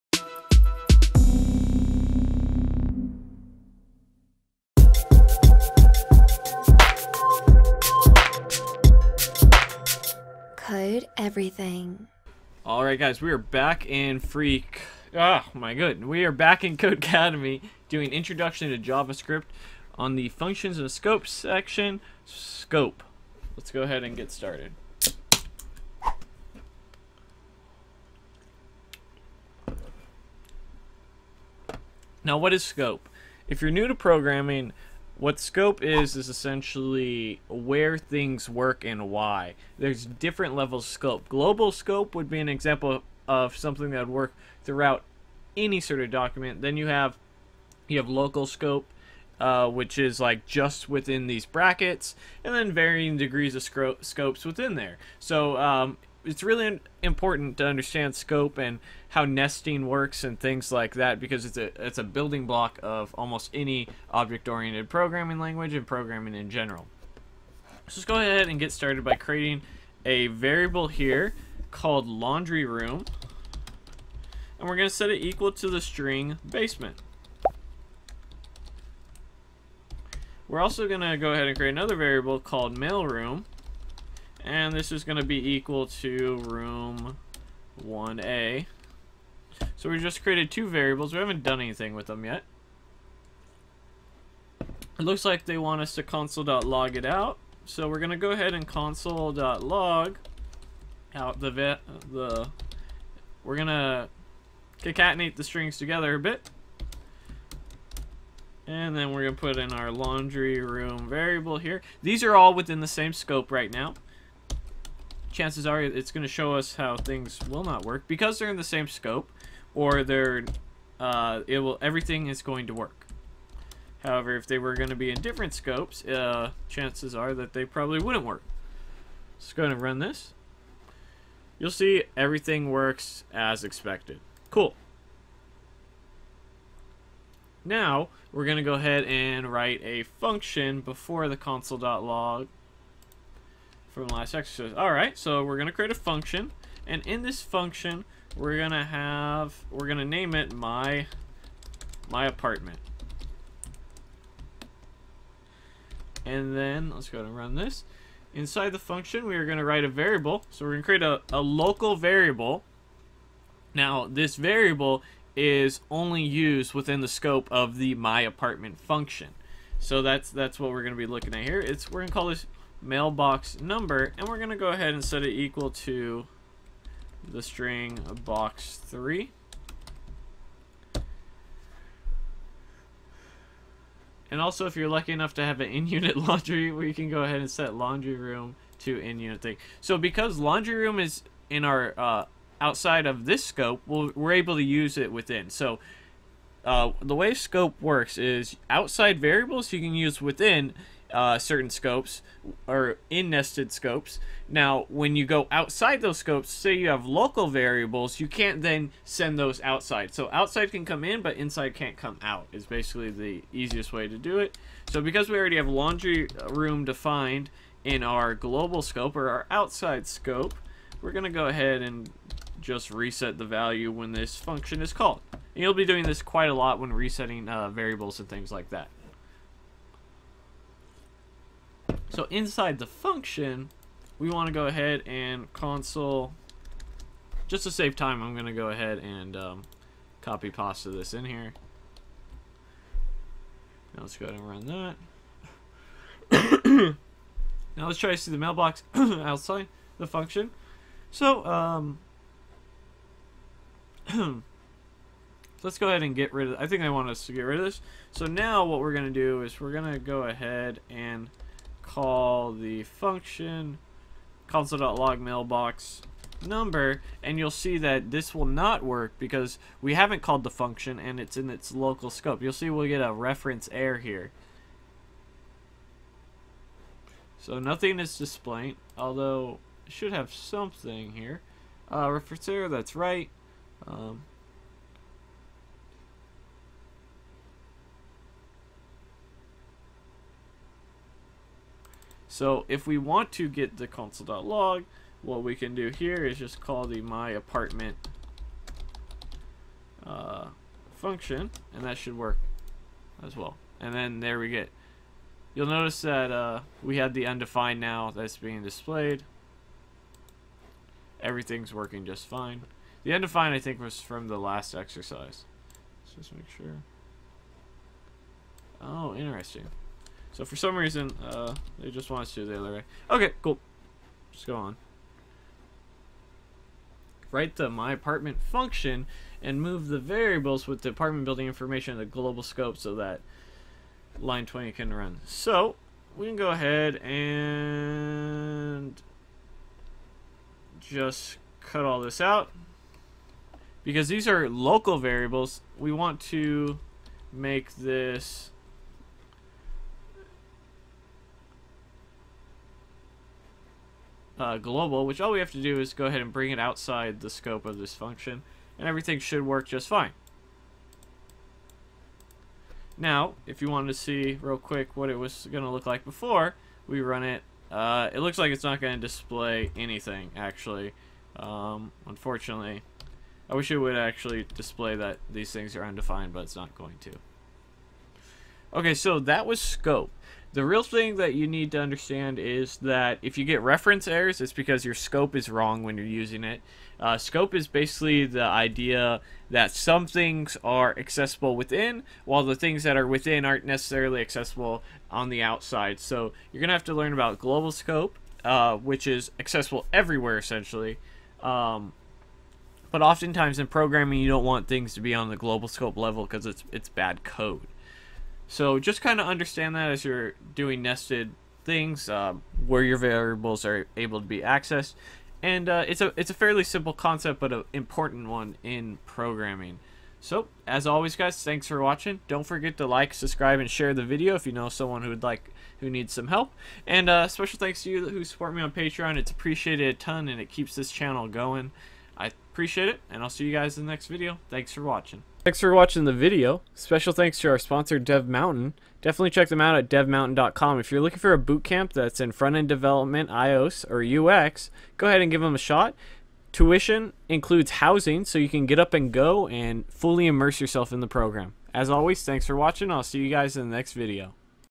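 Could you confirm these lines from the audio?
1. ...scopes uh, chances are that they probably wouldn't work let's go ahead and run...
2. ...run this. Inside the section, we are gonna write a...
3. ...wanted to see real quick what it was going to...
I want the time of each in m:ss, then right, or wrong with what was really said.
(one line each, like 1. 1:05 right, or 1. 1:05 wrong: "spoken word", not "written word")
1. 2:05 right
2. 2:37 wrong: "function", not "section"
3. 6:03 right.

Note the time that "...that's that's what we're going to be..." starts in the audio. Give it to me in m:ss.
2:50.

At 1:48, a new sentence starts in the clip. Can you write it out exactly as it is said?
And then we're going to put in our laundry room variable here.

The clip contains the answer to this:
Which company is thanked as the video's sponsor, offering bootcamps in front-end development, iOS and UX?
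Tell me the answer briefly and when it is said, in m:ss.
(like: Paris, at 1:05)
DevMountain, at 7:17.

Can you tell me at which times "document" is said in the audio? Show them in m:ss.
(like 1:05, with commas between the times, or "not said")
0:46.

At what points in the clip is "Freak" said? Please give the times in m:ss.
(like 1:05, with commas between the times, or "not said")
0:14.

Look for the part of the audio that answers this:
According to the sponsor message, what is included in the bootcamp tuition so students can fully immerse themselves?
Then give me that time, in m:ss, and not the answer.
7:27.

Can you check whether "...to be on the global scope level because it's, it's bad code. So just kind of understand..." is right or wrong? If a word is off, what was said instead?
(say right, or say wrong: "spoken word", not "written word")
right.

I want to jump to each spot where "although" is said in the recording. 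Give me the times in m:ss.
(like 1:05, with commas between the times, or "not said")
4:38.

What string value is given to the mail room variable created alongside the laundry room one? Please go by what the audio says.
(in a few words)
room 1A.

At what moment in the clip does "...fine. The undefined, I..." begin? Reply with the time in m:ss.
5:12.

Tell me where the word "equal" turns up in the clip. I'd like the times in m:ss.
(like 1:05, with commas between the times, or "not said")
1:15, 1:25, 2:55.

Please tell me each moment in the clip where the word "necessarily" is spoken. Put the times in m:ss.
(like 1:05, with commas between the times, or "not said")
6:33.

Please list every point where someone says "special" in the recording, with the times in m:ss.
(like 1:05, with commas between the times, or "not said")
7:07, 7:16.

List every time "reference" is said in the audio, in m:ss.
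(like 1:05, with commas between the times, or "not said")
4:33, 4:42, 6:23.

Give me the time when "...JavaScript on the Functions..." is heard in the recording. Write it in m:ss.
0:18.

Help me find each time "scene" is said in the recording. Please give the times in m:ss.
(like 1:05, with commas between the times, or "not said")
not said.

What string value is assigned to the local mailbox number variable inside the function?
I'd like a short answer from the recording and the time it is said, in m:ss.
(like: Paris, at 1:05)
box 3, at 2:58.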